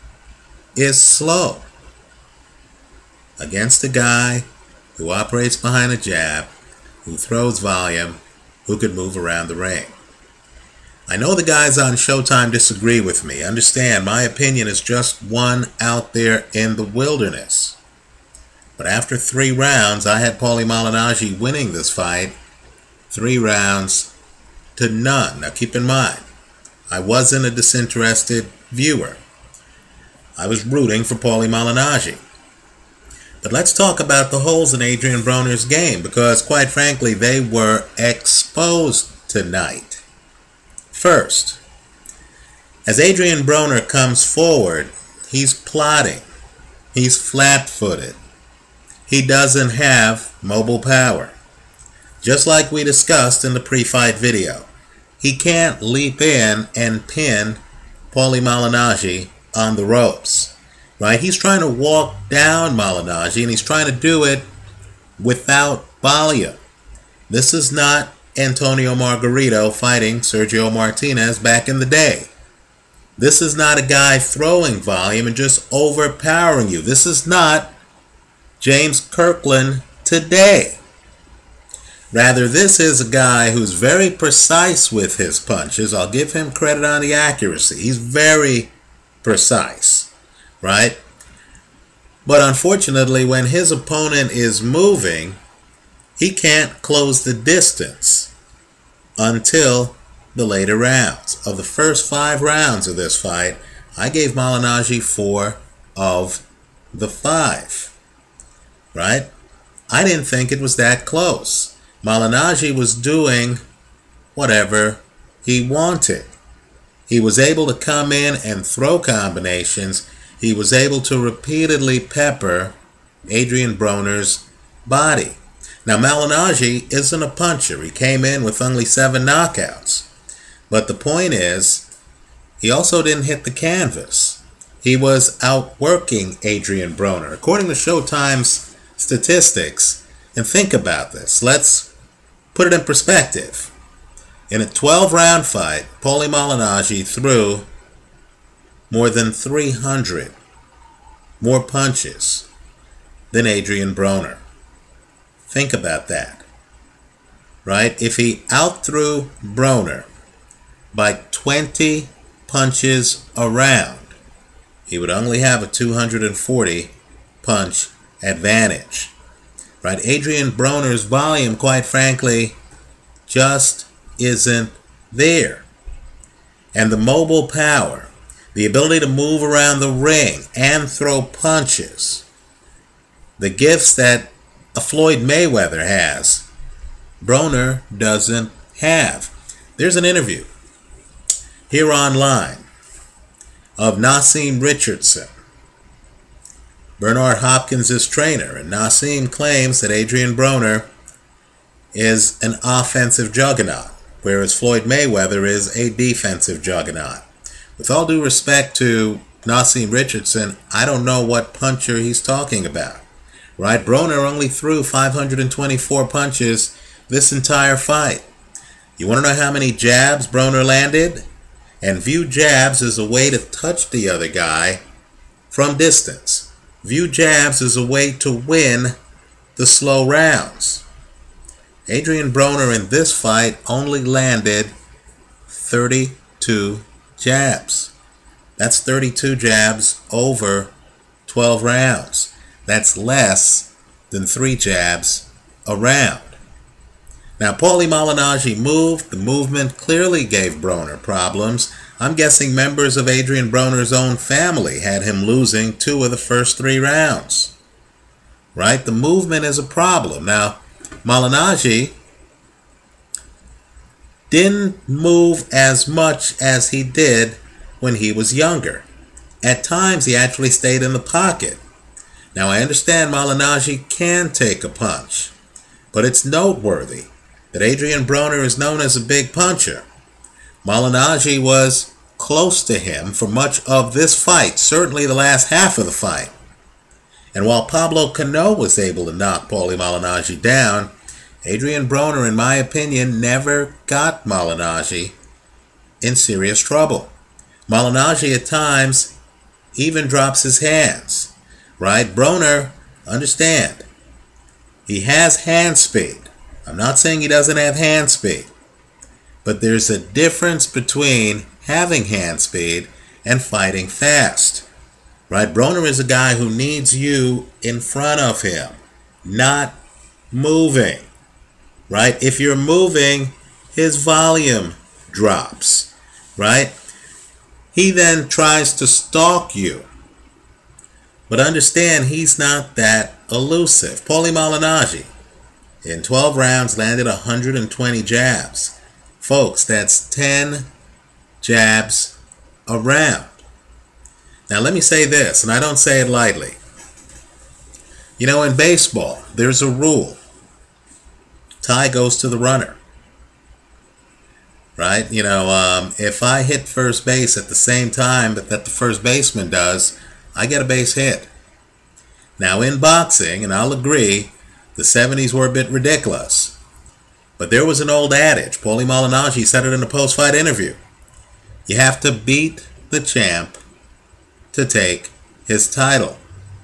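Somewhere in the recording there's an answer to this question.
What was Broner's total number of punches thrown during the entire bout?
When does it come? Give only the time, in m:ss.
3:34.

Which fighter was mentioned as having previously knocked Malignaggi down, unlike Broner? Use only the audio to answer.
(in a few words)
Pablo Cano.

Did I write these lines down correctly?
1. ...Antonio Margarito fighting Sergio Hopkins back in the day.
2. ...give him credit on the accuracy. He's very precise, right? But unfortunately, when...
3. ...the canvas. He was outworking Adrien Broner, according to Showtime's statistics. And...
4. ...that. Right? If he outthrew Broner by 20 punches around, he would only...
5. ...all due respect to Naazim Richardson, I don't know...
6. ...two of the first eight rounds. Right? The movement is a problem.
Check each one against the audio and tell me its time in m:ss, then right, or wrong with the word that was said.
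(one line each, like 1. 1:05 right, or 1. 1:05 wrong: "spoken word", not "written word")
1. 1:08 wrong: "Martinez", not "Hopkins"
2. 1:26 right
3. 2:13 right
4. 2:36 right
5. 3:27 right
6. 4:15 wrong: "three", not "eight".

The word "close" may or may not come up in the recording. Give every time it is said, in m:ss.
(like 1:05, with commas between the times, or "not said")
1:36, 1:51, 4:42.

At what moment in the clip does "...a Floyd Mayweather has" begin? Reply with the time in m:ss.
3:04.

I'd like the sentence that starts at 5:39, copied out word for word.
Folks, that's 10 jabs a round.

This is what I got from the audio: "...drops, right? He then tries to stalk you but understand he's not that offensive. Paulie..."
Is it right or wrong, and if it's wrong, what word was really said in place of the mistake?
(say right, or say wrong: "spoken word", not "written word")
wrong: "elusive", not "offensive".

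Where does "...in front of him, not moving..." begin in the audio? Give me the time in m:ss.
5:17.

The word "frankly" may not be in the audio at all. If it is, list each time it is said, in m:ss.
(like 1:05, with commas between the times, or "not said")
0:36, 2:51.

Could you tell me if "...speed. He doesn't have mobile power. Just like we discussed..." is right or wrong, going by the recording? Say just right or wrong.
wrong.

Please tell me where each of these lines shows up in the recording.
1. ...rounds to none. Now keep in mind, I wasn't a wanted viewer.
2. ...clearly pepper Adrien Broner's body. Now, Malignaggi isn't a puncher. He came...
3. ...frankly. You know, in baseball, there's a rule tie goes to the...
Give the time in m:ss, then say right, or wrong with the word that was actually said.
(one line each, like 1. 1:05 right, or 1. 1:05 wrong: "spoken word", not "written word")
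1. 0:23 wrong: "disinterested", not "wanted"
2. 2:01 wrong: "repeatedly", not "clearly"
3. 5:46 wrong: "lightly", not "frankly".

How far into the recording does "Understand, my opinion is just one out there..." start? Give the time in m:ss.
0:13.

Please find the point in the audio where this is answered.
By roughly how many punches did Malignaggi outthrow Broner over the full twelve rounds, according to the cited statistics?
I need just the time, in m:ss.
2:28.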